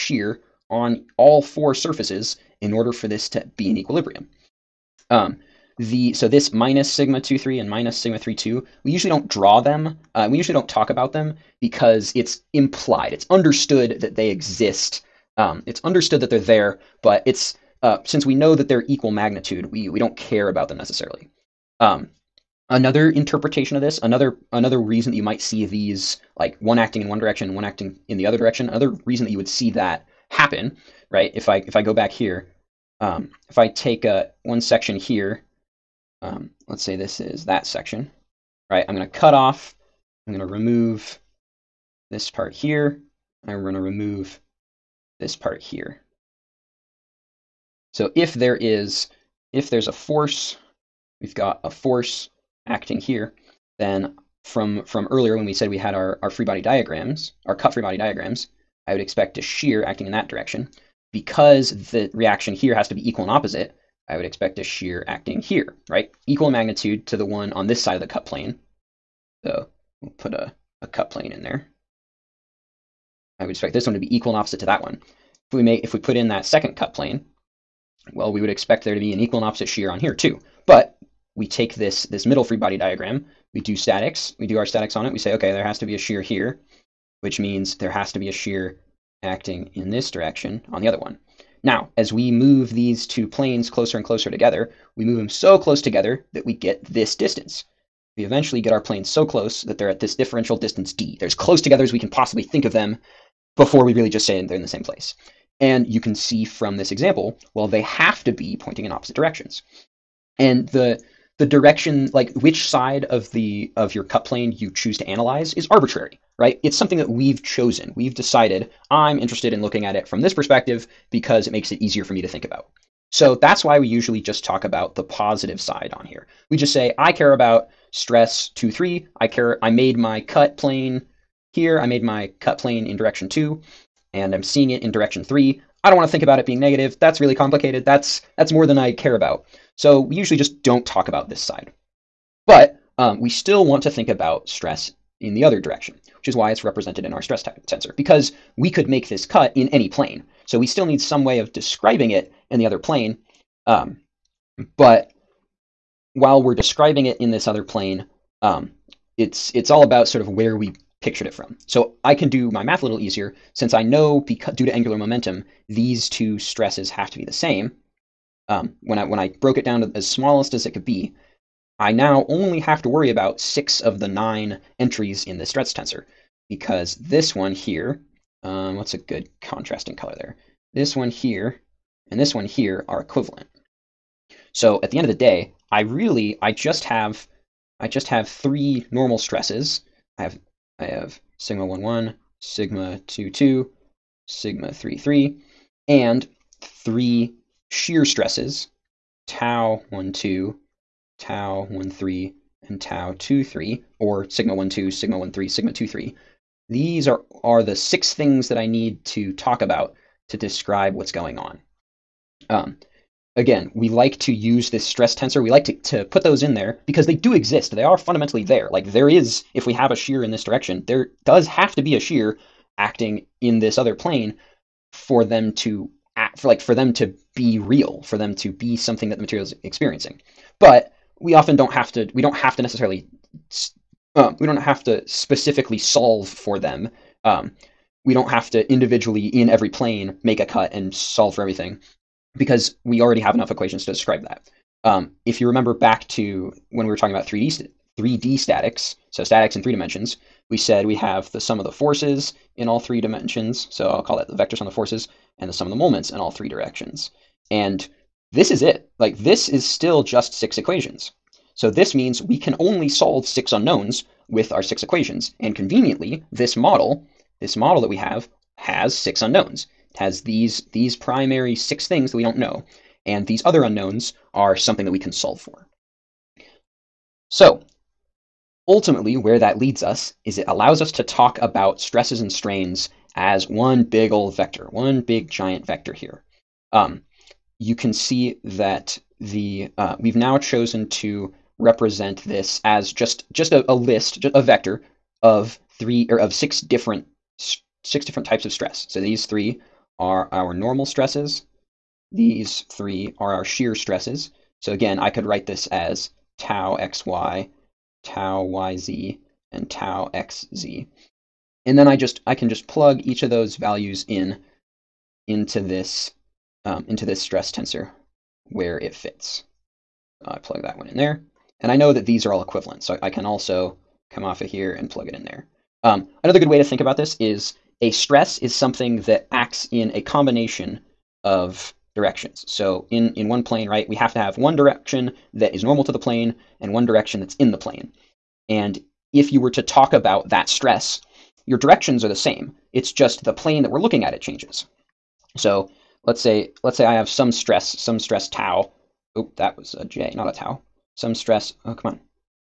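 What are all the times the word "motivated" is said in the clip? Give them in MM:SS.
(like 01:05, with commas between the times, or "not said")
not said.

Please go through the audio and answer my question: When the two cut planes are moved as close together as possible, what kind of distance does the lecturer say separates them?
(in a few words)
differential distance.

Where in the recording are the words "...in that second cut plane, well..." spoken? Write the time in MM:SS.
01:16.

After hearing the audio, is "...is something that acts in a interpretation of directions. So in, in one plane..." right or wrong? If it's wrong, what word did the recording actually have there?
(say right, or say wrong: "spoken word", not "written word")
wrong: "combination", not "interpretation".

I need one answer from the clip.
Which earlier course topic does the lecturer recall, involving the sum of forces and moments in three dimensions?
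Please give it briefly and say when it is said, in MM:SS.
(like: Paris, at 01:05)
3D statics, at 04:07.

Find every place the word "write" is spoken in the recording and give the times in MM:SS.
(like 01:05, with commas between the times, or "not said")
05:05.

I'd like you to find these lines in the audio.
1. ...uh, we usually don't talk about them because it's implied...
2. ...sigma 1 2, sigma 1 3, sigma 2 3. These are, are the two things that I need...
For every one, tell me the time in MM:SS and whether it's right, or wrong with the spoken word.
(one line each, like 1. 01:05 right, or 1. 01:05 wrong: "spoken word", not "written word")
1. 00:10 right
2. 03:24 wrong: "six", not "two".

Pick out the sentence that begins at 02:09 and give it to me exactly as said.
I care, I made my cut plane here.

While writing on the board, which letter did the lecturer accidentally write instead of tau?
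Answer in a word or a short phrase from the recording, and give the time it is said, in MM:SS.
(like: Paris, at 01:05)
J, at 05:49.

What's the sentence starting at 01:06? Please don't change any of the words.
Equal in magnitude to the one on this side of the cut plane.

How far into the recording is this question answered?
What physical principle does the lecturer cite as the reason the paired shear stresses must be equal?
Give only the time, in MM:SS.
02:44.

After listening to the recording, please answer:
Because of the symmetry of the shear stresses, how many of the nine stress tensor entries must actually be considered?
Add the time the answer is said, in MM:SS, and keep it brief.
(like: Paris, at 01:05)
6, at 02:53.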